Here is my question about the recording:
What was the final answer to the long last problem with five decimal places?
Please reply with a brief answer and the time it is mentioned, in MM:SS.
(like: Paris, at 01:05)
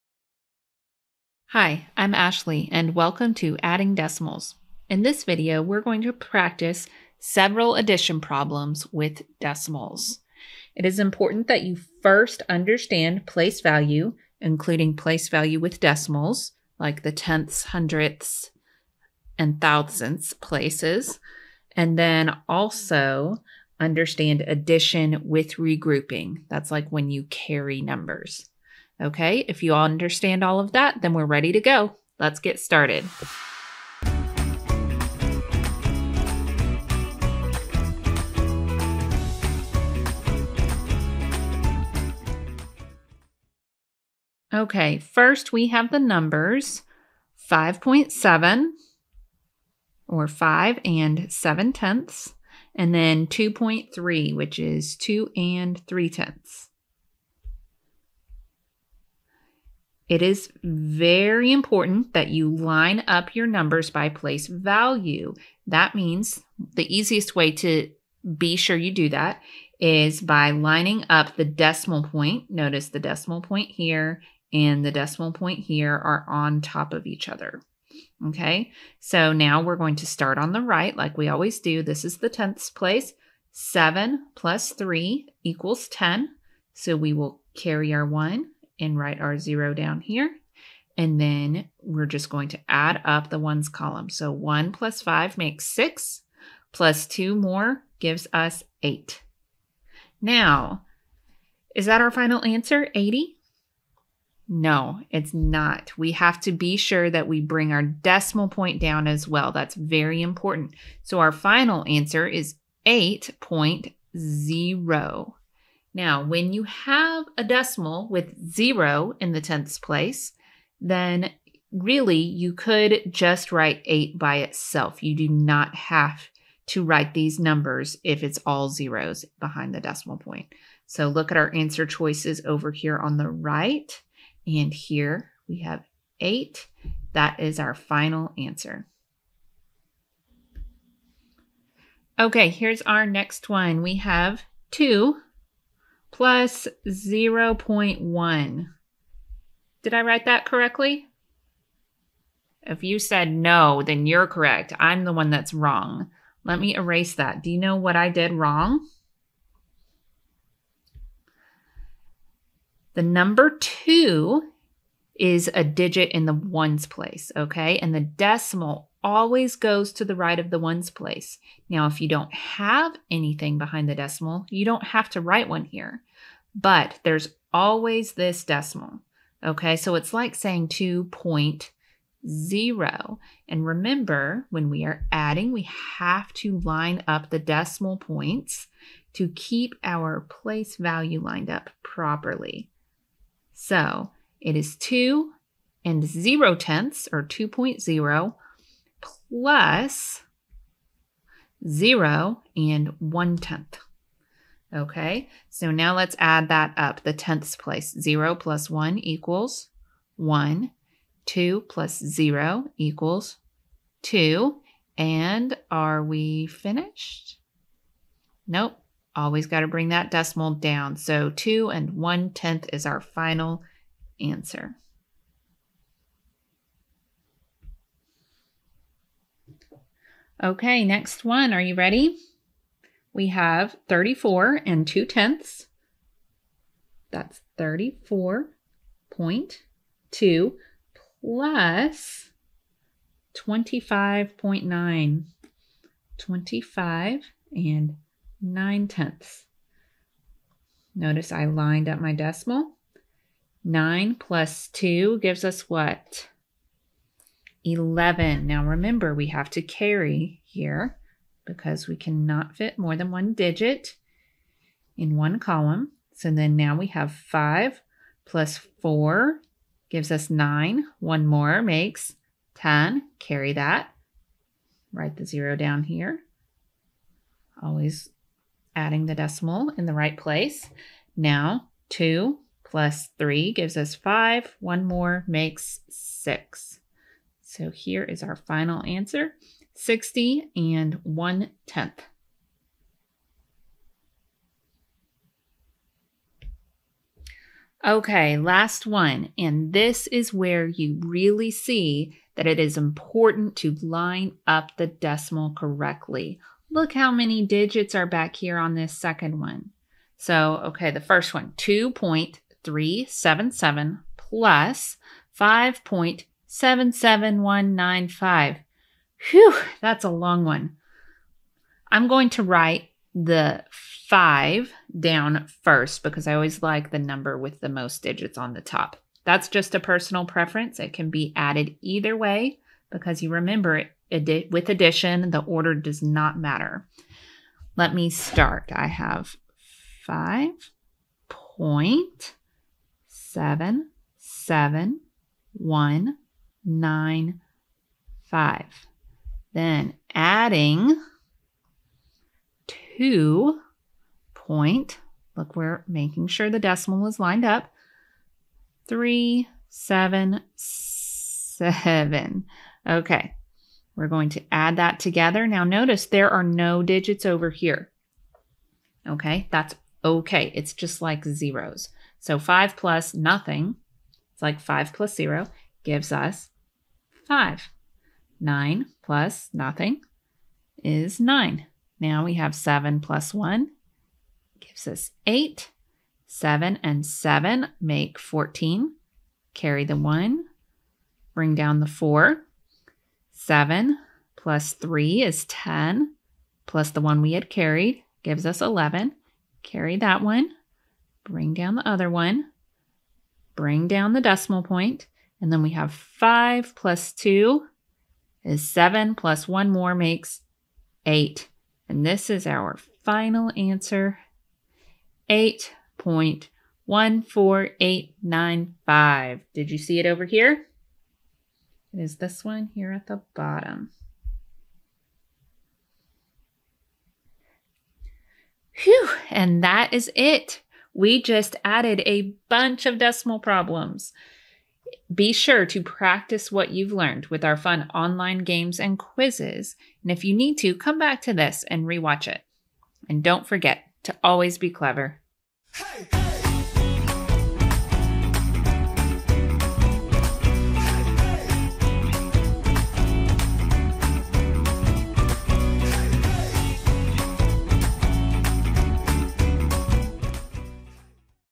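8.14895, at 06:55.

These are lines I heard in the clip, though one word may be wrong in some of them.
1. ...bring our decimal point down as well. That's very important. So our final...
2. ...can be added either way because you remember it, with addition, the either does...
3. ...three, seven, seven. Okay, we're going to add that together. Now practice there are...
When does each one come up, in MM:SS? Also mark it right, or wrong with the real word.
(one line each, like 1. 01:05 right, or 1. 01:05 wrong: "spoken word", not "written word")
1. 01:47 right
2. 05:30 wrong: "order", not "either"
3. 05:58 wrong: "notice", not "practice".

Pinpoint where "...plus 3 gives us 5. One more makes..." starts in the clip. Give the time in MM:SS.
04:42.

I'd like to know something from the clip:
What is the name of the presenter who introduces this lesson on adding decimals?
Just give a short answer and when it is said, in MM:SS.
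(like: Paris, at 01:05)
Ashley, at 00:02.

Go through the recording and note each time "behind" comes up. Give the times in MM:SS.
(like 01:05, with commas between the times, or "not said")
02:09, 02:53.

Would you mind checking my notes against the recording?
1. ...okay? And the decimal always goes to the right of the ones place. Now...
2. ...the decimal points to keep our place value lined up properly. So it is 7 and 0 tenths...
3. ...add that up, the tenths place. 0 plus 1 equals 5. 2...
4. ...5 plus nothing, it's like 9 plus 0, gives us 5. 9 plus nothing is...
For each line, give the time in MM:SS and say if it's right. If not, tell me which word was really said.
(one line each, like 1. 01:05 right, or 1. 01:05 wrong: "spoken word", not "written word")
1. 02:47 right
2. 03:07 wrong: "2", not "7"
3. 03:26 wrong: "1", not "5"
4. 06:12 wrong: "5", not "9".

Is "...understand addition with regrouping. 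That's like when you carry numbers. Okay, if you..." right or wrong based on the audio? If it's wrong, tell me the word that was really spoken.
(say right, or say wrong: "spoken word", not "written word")
right.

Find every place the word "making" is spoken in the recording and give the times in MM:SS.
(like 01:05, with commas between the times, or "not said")
05:55.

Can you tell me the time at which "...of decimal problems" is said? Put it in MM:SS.
07:12.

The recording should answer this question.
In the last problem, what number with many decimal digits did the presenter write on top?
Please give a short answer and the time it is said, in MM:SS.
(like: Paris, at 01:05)
5.77195, at 05:15.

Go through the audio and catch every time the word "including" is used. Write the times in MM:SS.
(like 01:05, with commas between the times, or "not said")
00:14.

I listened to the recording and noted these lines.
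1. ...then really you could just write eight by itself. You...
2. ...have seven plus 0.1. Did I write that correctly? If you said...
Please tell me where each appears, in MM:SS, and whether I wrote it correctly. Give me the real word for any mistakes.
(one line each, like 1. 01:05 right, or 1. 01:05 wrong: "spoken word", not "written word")
1. 02:00 right
2. 02:23 wrong: "two", not "seven".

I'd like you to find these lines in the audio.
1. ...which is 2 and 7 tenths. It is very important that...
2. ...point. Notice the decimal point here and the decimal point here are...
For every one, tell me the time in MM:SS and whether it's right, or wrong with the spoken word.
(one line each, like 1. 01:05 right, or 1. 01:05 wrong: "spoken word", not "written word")
1. 00:54 wrong: "3", not "7"
2. 01:12 right.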